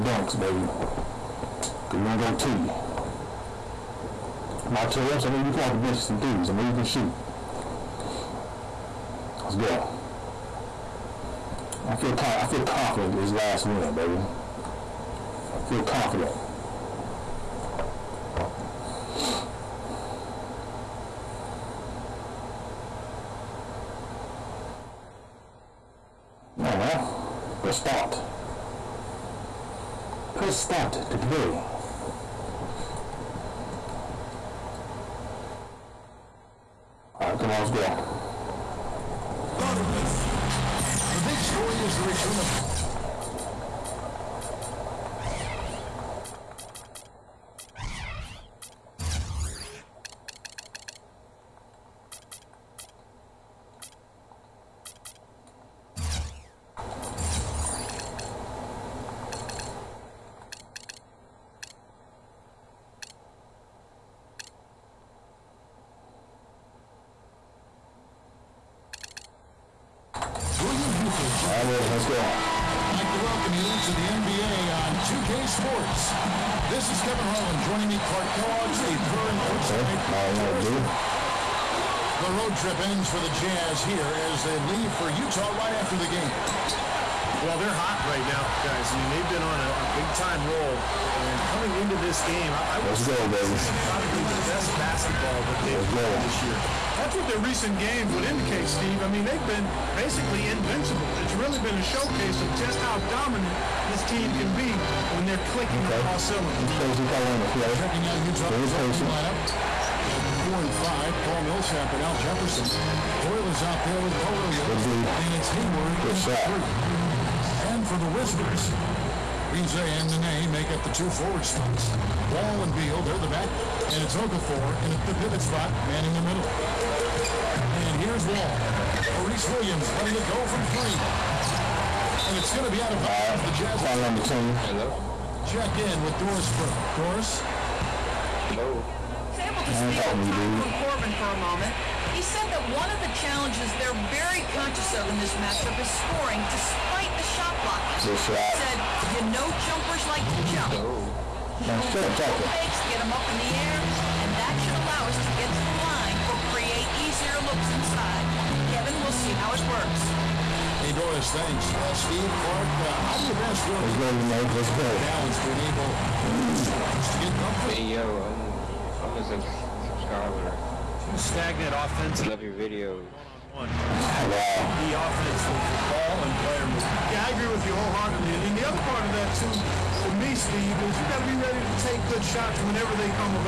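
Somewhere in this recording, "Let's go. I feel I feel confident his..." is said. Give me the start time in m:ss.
0:09.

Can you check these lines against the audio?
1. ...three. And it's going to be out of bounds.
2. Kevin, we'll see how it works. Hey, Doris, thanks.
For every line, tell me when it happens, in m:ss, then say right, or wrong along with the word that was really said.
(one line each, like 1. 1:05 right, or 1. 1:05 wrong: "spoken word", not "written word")
1. 2:10 right
2. 2:38 right.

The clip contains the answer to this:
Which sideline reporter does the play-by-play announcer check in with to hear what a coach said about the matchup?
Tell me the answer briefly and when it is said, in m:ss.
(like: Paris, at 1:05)
Doris Burke, at 2:16.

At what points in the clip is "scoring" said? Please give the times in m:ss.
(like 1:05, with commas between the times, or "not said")
2:25.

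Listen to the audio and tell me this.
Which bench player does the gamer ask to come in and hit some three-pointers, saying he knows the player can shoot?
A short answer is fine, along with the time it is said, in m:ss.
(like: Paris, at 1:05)
Martell Webster, at 0:04.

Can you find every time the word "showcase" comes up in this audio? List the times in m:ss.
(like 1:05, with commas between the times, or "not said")
1:41.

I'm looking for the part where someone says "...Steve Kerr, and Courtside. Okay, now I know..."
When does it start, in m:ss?
1:18.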